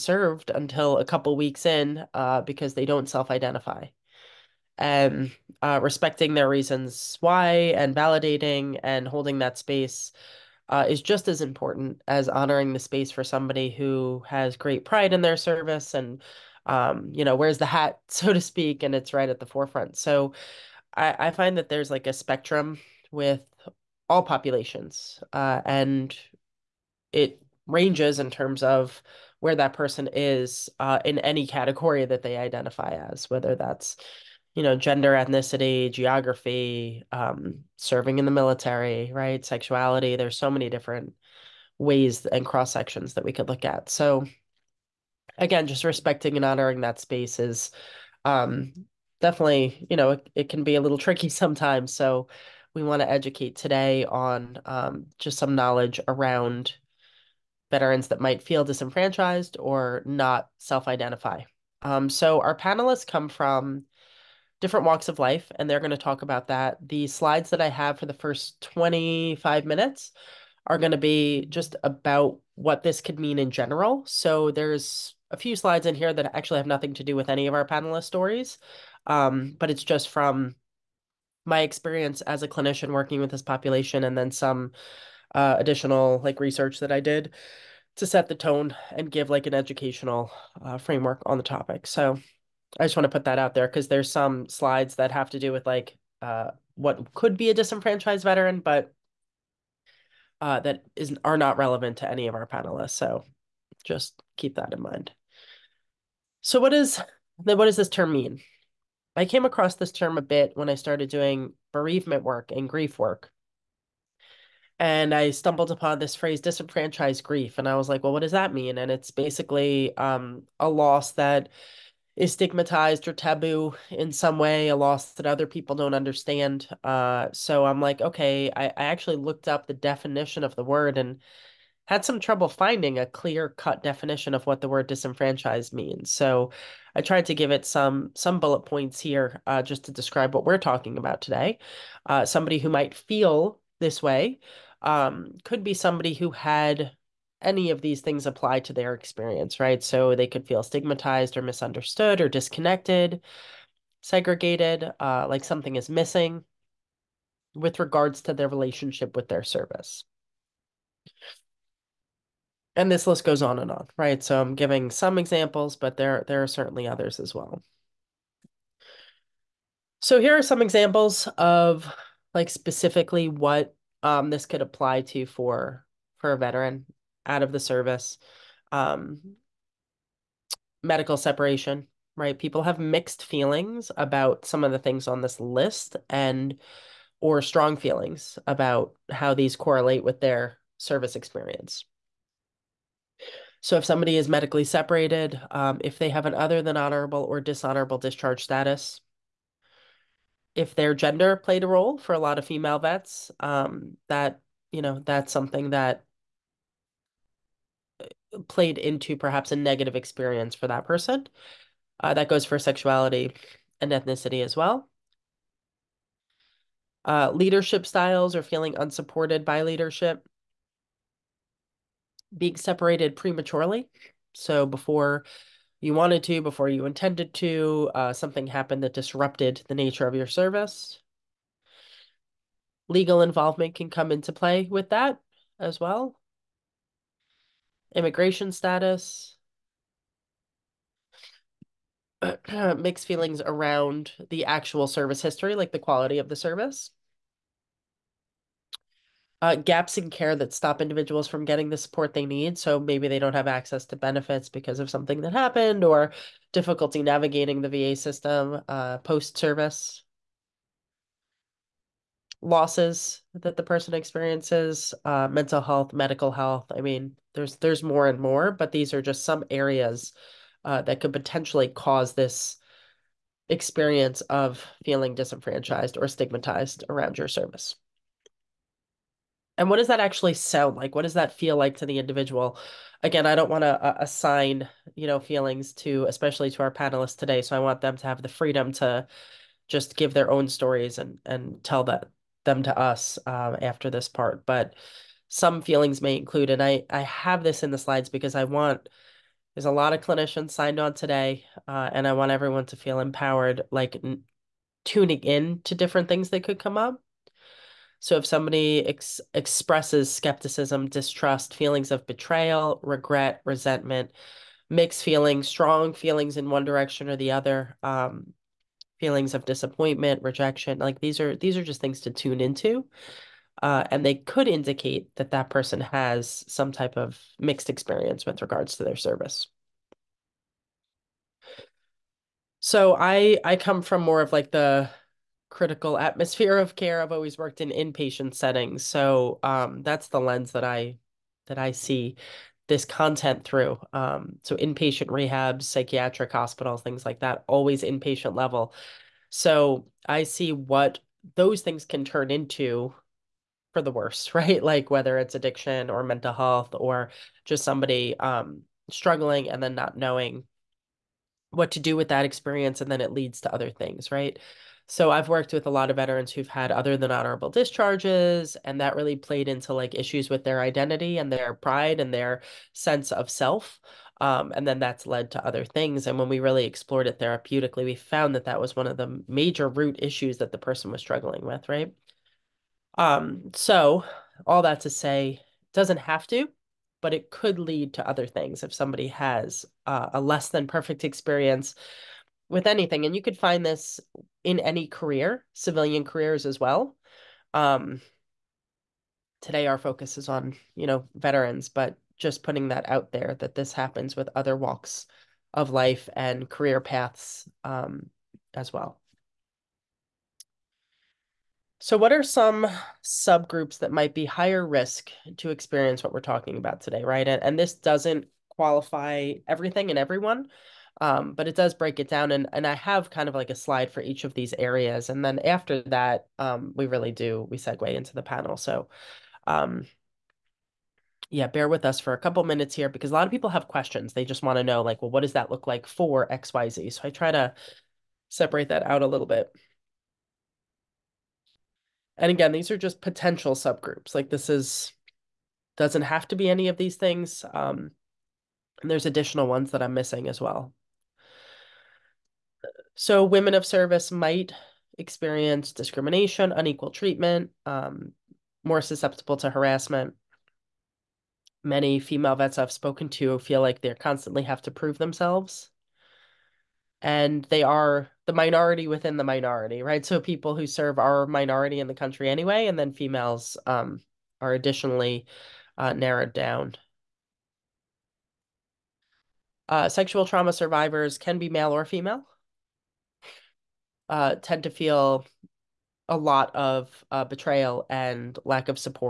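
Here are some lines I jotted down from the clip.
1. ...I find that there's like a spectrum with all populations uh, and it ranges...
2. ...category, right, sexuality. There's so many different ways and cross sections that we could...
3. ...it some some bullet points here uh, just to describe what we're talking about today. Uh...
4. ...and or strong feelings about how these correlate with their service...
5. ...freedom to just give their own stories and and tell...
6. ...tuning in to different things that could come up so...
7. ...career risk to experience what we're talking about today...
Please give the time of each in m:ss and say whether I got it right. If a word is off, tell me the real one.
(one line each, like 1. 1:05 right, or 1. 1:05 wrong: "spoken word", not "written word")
1. 0:21 right
2. 0:38 wrong: "military", not "category"
3. 2:17 right
4. 3:06 right
5. 4:48 right
6. 5:04 right
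7. 6:54 wrong: "higher", not "career".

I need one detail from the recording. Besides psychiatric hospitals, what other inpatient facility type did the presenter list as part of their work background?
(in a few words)
inpatient rehabs.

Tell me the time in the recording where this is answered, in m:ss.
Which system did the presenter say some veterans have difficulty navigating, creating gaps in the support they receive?
4:17.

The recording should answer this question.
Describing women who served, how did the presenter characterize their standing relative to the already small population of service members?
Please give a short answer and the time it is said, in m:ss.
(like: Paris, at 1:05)
minority within the minority, at 7:48.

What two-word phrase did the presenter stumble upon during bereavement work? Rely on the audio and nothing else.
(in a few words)
disenfranchised grief.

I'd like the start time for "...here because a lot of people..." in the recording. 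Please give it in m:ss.
7:12.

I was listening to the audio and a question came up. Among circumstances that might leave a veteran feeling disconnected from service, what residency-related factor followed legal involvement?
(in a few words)
Immigration status.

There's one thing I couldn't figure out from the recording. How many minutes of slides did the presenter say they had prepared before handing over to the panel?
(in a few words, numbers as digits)
25.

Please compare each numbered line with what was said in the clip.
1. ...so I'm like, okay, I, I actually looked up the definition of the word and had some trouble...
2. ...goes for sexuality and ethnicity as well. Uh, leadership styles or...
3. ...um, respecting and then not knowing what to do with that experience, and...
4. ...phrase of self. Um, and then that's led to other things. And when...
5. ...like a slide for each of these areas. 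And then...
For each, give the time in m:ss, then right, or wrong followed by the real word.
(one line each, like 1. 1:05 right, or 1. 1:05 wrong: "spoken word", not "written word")
1. 2:07 right
2. 3:32 right
3. 5:58 wrong: "struggling", not "respecting"
4. 6:12 wrong: "sense", not "phrase"
5. 7:03 right.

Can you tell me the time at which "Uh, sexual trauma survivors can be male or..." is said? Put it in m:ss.
7:59.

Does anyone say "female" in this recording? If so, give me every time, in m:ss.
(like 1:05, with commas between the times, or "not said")
3:22, 7:41, 7:52, 8:01.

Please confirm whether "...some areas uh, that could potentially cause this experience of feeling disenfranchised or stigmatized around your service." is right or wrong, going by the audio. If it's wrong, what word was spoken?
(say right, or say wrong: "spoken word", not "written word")
right.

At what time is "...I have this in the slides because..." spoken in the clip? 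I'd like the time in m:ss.
4:56.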